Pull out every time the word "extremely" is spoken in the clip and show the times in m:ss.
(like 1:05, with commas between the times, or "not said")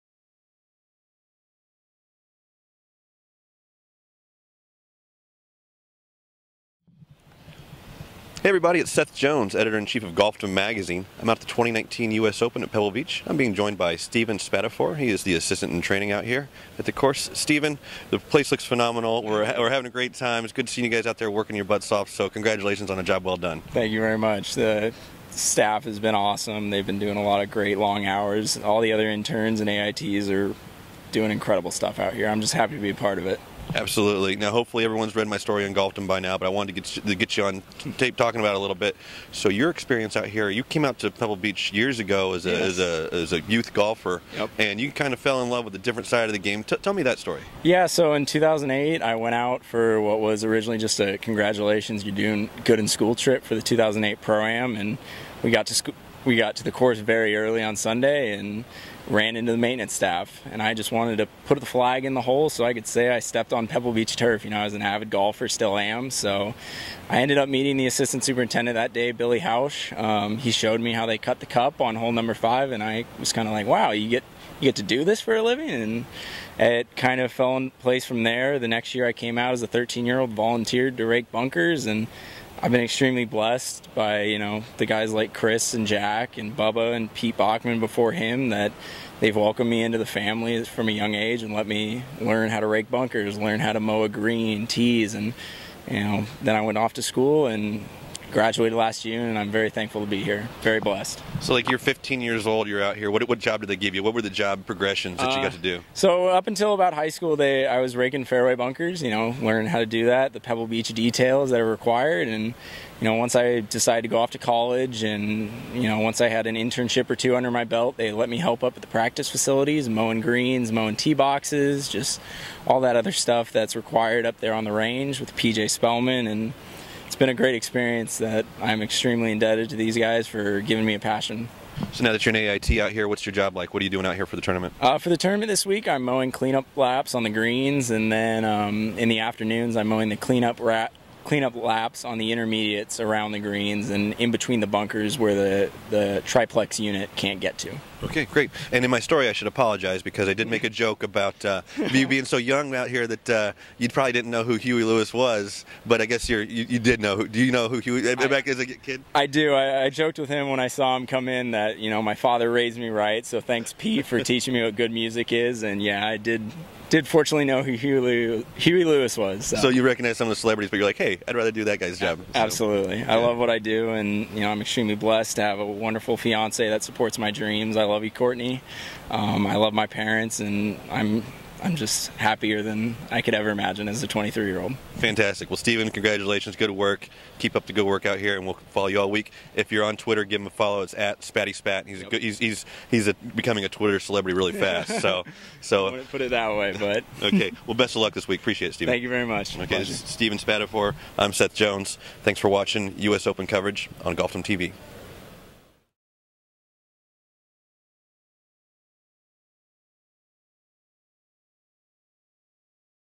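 1:22, 2:08, 2:54.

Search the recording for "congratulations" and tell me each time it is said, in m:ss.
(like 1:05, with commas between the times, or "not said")
0:22, 0:51, 3:05.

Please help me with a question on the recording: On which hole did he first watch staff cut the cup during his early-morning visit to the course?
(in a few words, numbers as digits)
5.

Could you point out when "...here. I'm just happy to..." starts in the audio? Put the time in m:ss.
0:32.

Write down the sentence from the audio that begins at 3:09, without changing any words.
If you're on Twitter, give him a follow.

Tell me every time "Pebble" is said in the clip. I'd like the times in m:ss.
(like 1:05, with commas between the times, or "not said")
0:12, 0:41, 1:03, 1:50.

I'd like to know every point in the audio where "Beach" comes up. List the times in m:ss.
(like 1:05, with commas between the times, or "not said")
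0:12, 0:41, 1:03, 1:50.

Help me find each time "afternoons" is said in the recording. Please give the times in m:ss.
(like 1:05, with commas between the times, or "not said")
2:19.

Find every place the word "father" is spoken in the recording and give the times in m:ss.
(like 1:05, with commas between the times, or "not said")
2:42.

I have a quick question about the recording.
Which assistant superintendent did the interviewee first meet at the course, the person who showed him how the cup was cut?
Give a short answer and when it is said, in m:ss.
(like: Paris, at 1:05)
Billy Hausch, at 1:09.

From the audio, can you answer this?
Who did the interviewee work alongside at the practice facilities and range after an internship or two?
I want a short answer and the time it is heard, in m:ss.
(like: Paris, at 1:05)
PJ Spellman, at 2:05.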